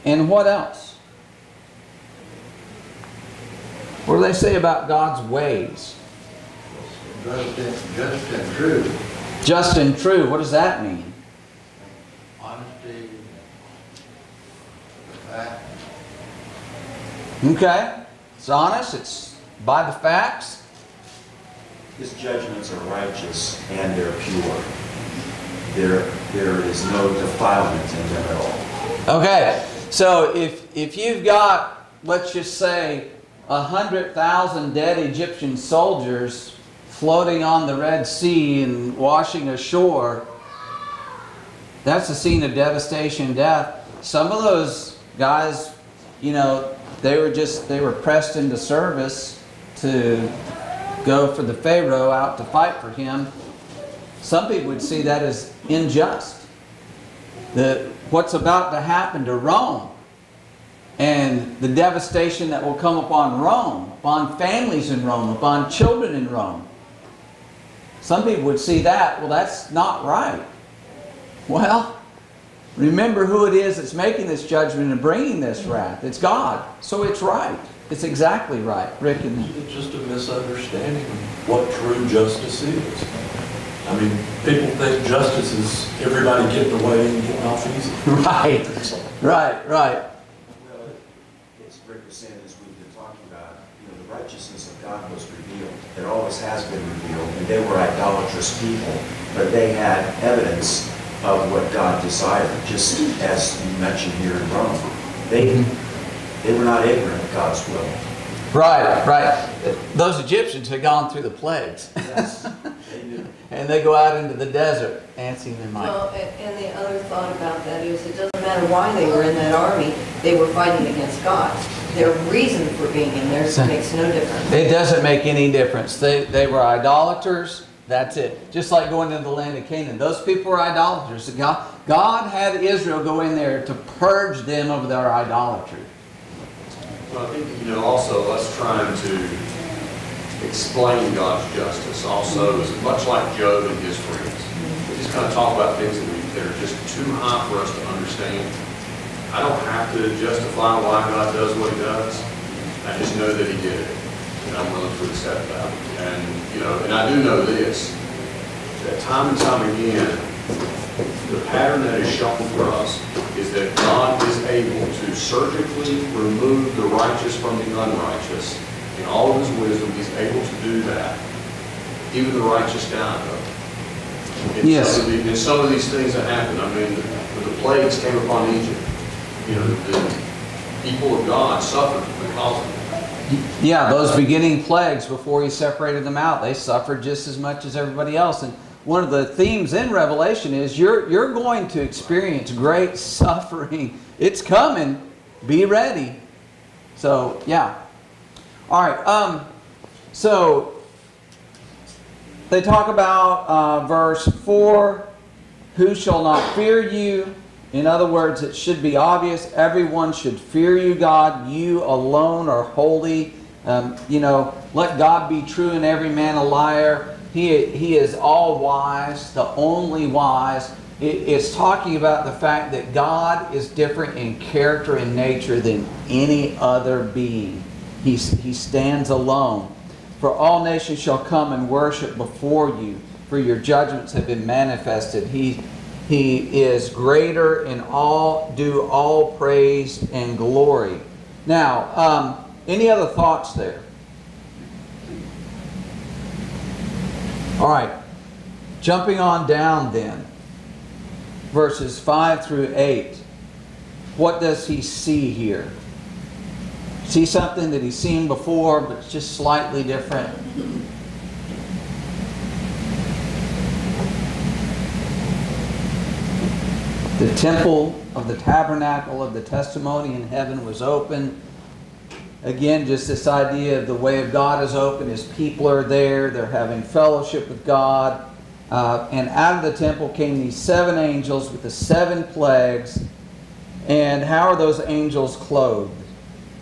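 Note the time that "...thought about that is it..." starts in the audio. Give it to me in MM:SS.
01:57.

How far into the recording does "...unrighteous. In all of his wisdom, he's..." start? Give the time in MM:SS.
02:47.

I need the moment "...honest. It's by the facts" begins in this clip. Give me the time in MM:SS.
00:18.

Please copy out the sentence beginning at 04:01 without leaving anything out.
Now, um, any other thoughts there?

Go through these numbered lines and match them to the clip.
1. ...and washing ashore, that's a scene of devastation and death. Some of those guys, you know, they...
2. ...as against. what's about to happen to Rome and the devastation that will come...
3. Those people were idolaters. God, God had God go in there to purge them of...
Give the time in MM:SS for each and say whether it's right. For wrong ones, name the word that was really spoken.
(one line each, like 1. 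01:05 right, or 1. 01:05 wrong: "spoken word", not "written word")
1. 00:38 right
2. 00:55 wrong: "unjust", not "against"
3. 02:09 wrong: "Israel", not "God".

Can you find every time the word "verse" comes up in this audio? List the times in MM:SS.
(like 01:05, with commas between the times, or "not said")
03:23, 04:11.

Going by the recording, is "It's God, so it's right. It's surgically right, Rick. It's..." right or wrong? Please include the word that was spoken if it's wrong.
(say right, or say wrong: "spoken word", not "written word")
wrong: "exactly", not "surgically".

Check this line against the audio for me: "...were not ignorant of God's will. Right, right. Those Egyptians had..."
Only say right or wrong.
right.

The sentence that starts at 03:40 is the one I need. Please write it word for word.
It, it's talking about the fact that God is different in character and nature than any other being.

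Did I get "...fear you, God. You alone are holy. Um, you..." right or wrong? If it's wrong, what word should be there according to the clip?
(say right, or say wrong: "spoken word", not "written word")
right.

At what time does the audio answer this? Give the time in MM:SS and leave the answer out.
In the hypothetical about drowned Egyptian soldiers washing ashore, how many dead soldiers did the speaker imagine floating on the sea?
00:33.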